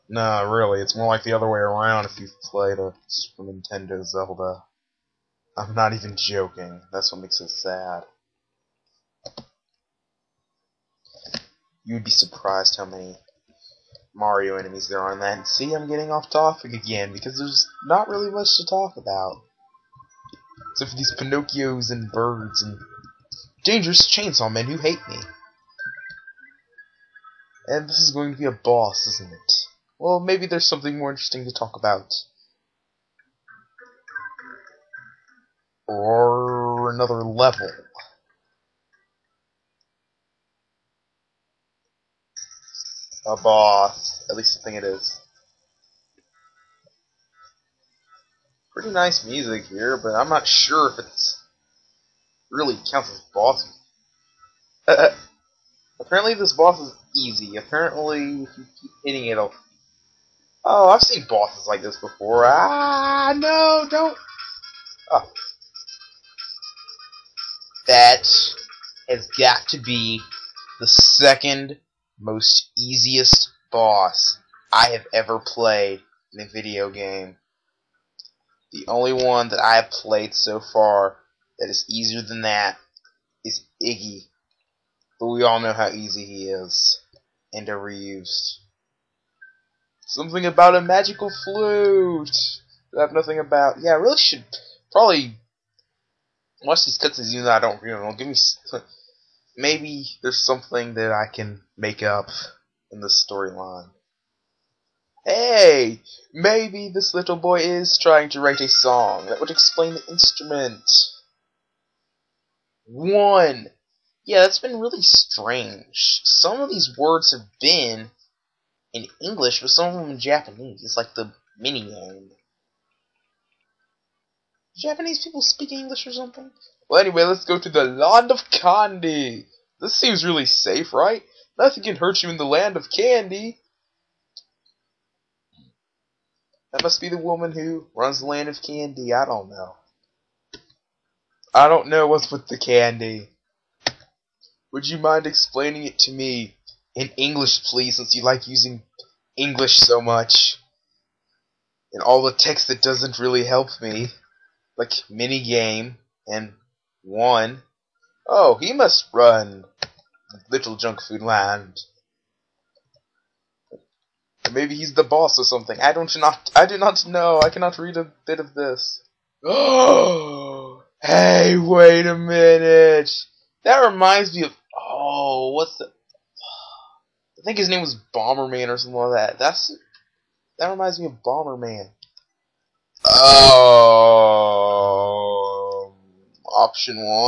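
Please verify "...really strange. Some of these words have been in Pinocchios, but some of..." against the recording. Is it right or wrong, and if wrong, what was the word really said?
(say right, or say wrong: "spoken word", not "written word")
wrong: "English", not "Pinocchios".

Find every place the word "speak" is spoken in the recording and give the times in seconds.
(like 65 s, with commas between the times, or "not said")
125 s.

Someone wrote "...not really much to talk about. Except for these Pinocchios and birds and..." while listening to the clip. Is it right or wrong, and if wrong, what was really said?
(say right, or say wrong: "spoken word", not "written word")
right.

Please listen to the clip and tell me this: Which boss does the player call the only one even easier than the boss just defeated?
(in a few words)
Iggy.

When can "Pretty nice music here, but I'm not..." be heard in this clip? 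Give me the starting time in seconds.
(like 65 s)
48 s.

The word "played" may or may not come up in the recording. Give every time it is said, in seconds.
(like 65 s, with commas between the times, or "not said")
2 s, 75 s, 79 s.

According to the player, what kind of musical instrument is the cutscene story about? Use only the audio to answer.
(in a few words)
magical flute.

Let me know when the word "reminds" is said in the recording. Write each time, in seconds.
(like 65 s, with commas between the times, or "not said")
173 s, 180 s.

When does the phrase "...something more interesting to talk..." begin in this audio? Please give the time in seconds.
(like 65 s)
30 s.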